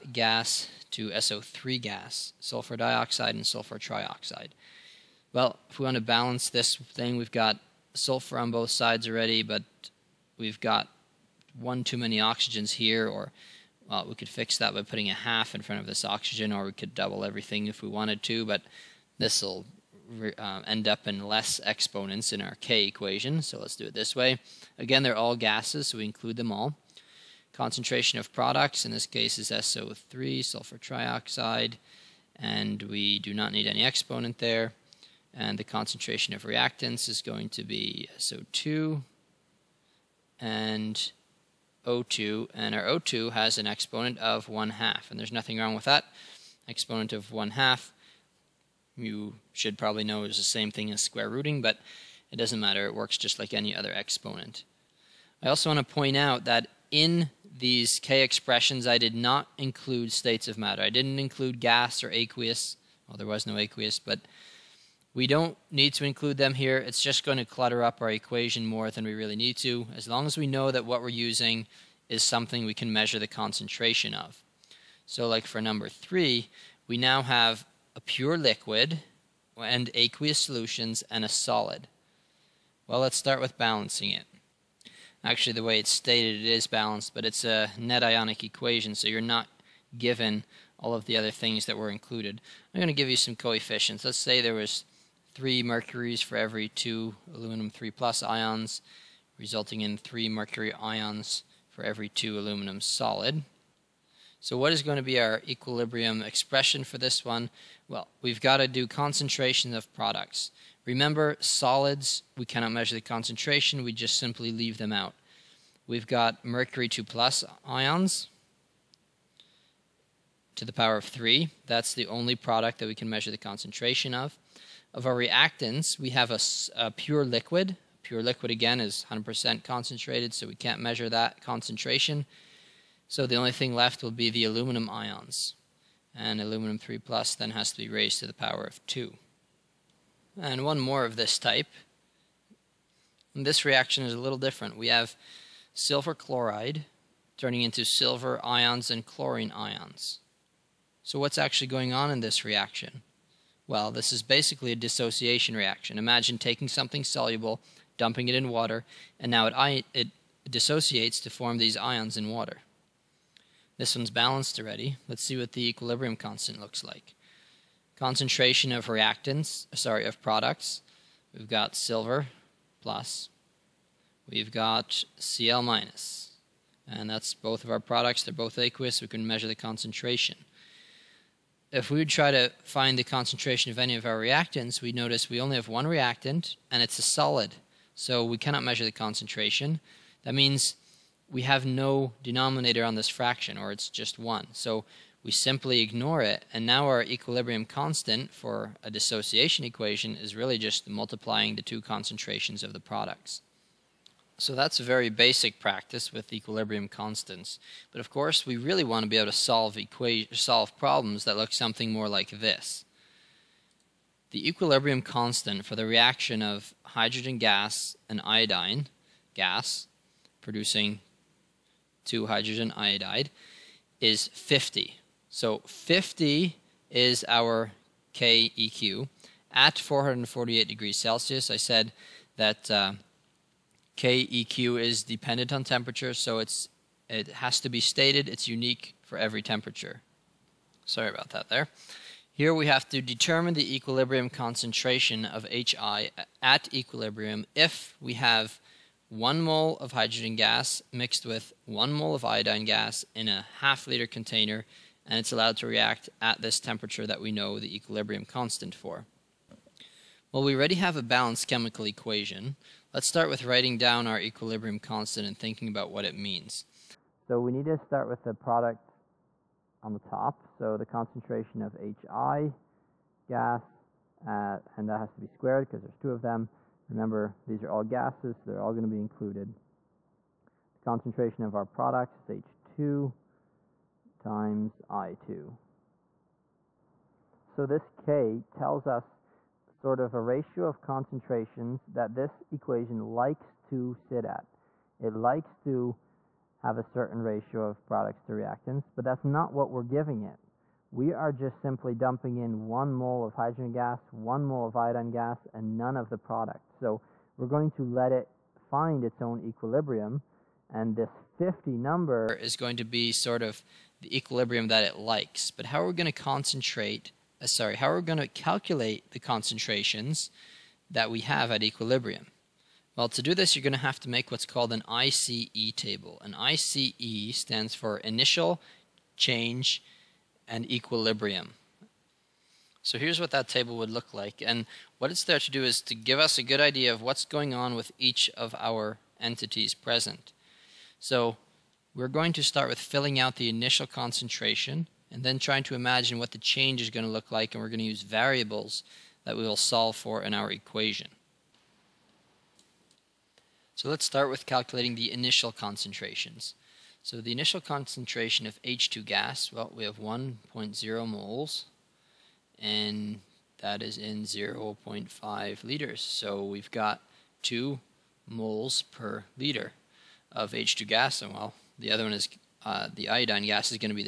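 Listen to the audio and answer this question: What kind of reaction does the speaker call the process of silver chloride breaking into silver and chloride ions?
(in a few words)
dissociation reaction.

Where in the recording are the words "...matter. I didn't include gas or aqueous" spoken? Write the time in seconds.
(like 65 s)
60 s.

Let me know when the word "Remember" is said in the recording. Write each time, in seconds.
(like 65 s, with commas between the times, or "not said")
110 s, 276 s.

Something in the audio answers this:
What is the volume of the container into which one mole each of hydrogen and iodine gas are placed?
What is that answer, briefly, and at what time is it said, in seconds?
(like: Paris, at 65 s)
half liter, at 253 s.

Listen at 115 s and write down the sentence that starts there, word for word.
We've got mercury 2 plus ions to the power of 3.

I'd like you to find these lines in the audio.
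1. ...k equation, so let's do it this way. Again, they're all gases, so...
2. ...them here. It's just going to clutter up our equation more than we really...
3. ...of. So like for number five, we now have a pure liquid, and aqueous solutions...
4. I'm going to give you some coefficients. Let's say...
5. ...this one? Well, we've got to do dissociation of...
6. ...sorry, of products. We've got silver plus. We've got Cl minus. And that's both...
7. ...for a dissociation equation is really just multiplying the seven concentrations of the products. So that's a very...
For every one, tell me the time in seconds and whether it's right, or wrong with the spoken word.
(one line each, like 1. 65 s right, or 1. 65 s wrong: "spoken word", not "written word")
1. 22 s right
2. 66 s right
3. 74 s wrong: "three", not "five"
4. 92 s right
5. 106 s wrong: "concentration", not "dissociation"
6. 169 s right
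7. 198 s wrong: "two", not "seven".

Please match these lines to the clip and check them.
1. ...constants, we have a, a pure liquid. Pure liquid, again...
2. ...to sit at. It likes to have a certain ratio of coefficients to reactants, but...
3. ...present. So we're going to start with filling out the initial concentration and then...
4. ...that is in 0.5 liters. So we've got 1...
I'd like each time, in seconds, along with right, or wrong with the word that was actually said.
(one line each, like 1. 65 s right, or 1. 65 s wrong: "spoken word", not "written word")
1. 125 s wrong: "reactants", not "constants"
2. 293 s wrong: "products", not "coefficients"
3. 339 s right
4. 363 s wrong: "2", not "1".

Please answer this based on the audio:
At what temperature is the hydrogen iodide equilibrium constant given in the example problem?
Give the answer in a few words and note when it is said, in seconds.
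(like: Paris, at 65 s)
448 degrees Celsius, at 229 s.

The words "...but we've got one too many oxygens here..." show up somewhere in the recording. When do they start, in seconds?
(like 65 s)
9 s.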